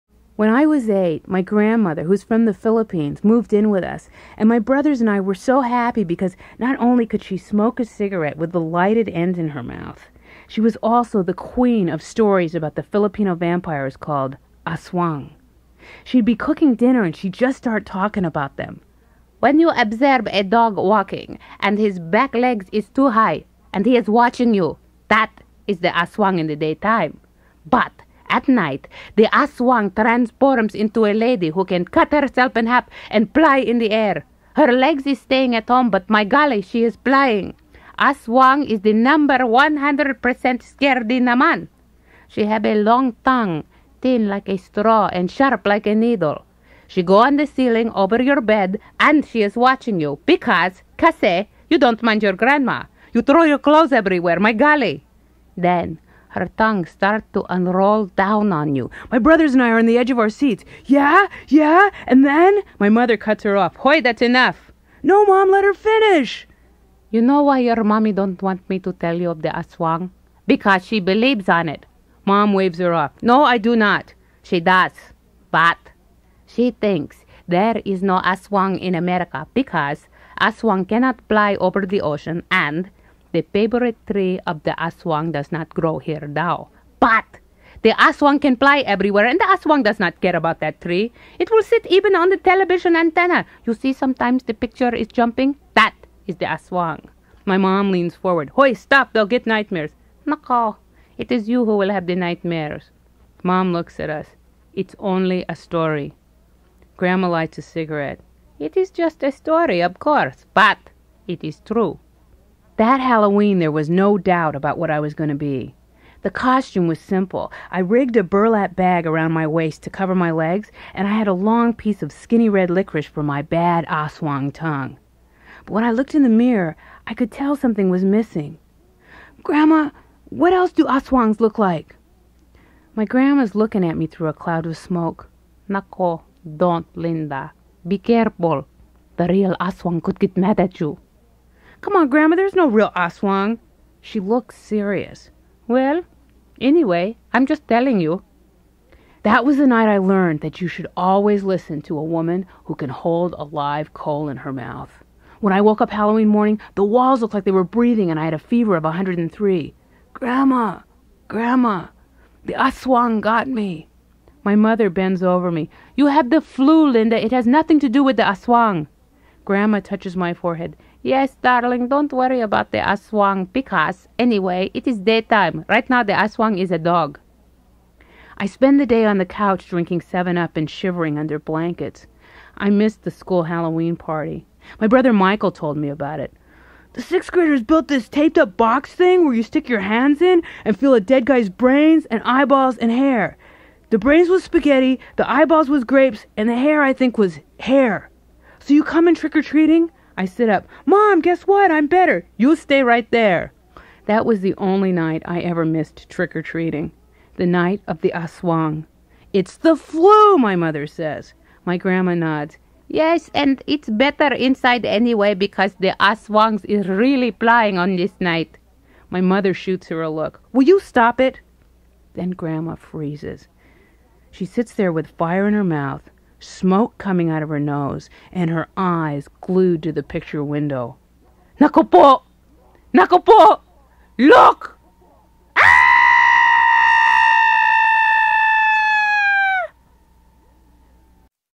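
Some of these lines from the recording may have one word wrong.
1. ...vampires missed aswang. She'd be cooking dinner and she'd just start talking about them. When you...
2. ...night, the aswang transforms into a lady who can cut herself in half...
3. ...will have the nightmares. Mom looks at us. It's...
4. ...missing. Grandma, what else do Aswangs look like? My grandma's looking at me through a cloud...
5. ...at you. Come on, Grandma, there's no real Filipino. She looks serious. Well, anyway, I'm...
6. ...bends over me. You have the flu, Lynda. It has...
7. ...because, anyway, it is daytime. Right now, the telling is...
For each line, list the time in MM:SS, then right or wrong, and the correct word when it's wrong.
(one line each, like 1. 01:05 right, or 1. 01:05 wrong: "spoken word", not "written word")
1. 00:13 wrong: "called", not "missed"
2. 00:28 right
3. 01:41 right
4. 02:08 right
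5. 02:20 wrong: "Aswang", not "Filipino"
6. 02:44 right
7. 02:53 wrong: "aswang", not "telling".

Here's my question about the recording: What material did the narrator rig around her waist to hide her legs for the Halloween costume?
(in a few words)
Burlap bag.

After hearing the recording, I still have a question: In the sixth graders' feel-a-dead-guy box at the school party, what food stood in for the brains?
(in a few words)
Spaghetti.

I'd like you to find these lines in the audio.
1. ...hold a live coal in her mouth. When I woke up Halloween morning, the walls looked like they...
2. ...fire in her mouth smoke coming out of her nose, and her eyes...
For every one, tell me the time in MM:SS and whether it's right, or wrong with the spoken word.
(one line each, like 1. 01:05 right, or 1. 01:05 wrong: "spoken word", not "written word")
1. 02:32 right
2. 03:45 right.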